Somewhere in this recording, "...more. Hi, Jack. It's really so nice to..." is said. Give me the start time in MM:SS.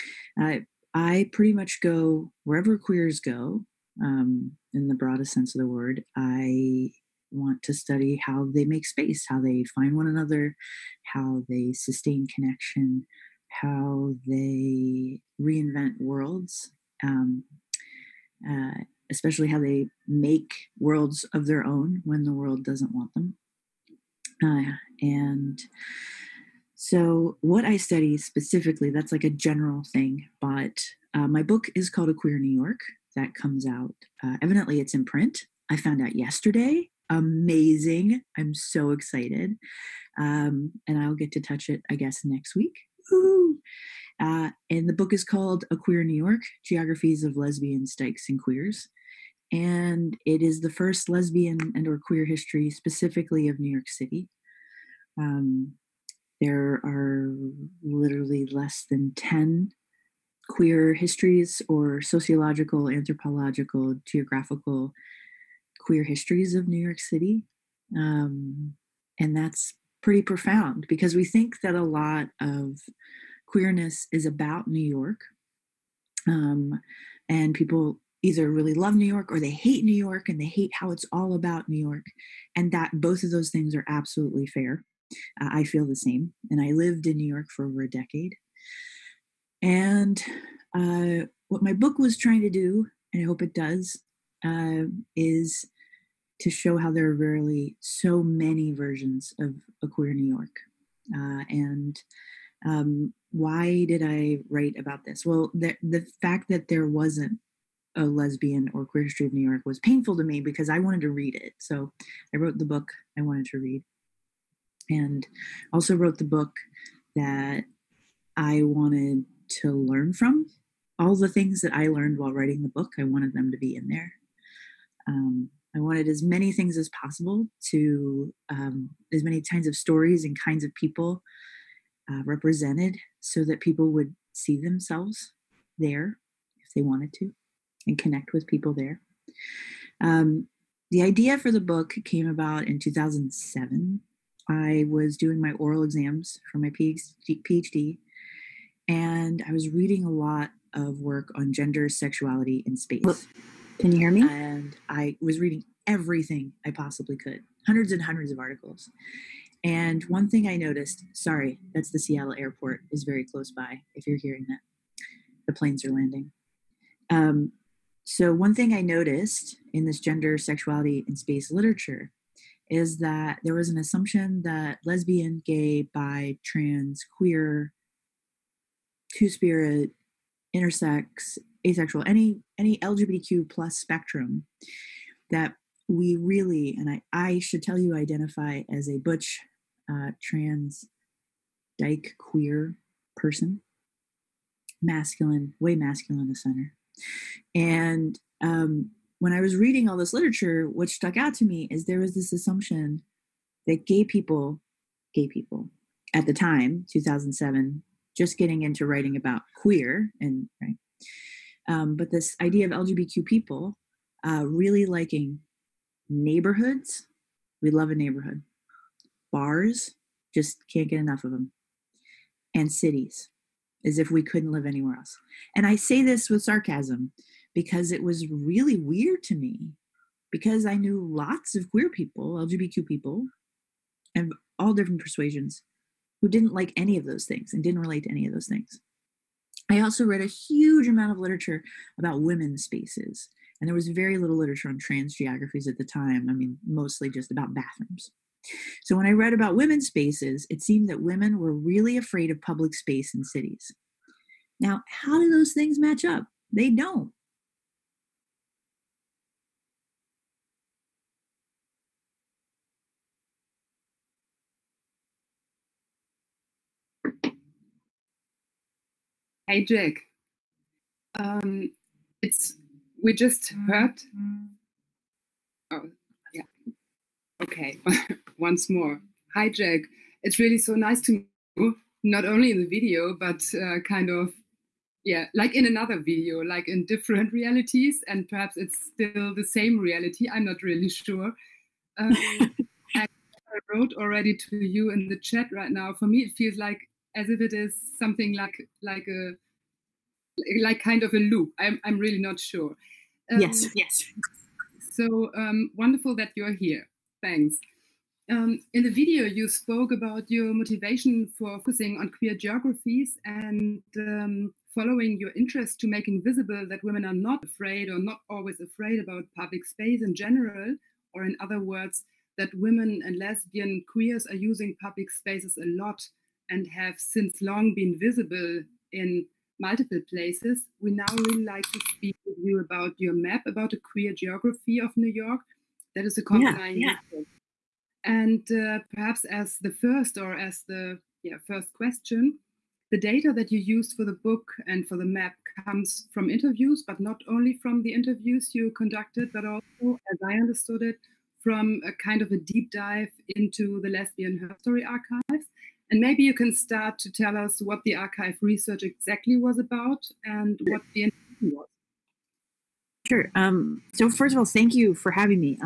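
04:38.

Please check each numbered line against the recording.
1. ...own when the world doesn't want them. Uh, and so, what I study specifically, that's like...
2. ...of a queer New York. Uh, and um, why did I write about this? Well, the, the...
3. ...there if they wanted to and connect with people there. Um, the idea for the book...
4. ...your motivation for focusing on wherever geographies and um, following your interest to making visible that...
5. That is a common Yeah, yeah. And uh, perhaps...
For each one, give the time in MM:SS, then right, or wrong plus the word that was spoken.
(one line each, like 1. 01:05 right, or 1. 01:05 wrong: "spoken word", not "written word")
1. 00:21 right
2. 01:39 right
3. 02:15 right
4. 05:10 wrong: "queer", not "wherever"
5. 05:35 right.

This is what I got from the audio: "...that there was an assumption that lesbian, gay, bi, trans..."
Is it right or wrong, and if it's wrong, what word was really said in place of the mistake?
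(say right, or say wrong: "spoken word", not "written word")
right.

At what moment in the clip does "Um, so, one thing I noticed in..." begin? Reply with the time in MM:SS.
02:47.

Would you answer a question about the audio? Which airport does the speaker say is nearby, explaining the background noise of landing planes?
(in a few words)
Seattle airport.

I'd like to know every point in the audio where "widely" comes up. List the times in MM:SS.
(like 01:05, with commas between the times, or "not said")
not said.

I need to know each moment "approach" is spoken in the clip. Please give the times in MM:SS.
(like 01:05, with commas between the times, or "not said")
not said.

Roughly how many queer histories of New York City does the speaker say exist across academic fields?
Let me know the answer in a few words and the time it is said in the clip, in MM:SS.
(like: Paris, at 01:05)
less than 10, at 00:58.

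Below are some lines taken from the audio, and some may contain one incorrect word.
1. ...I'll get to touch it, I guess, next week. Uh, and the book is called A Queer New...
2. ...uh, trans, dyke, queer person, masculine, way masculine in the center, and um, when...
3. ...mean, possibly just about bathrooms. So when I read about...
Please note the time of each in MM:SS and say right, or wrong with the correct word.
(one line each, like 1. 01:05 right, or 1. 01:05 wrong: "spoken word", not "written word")
1. 00:40 right
2. 03:09 right
3. 04:06 wrong: "mostly", not "possibly".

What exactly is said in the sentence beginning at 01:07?
Um, and that's pretty profound because we think that a lot of queerness is about New York.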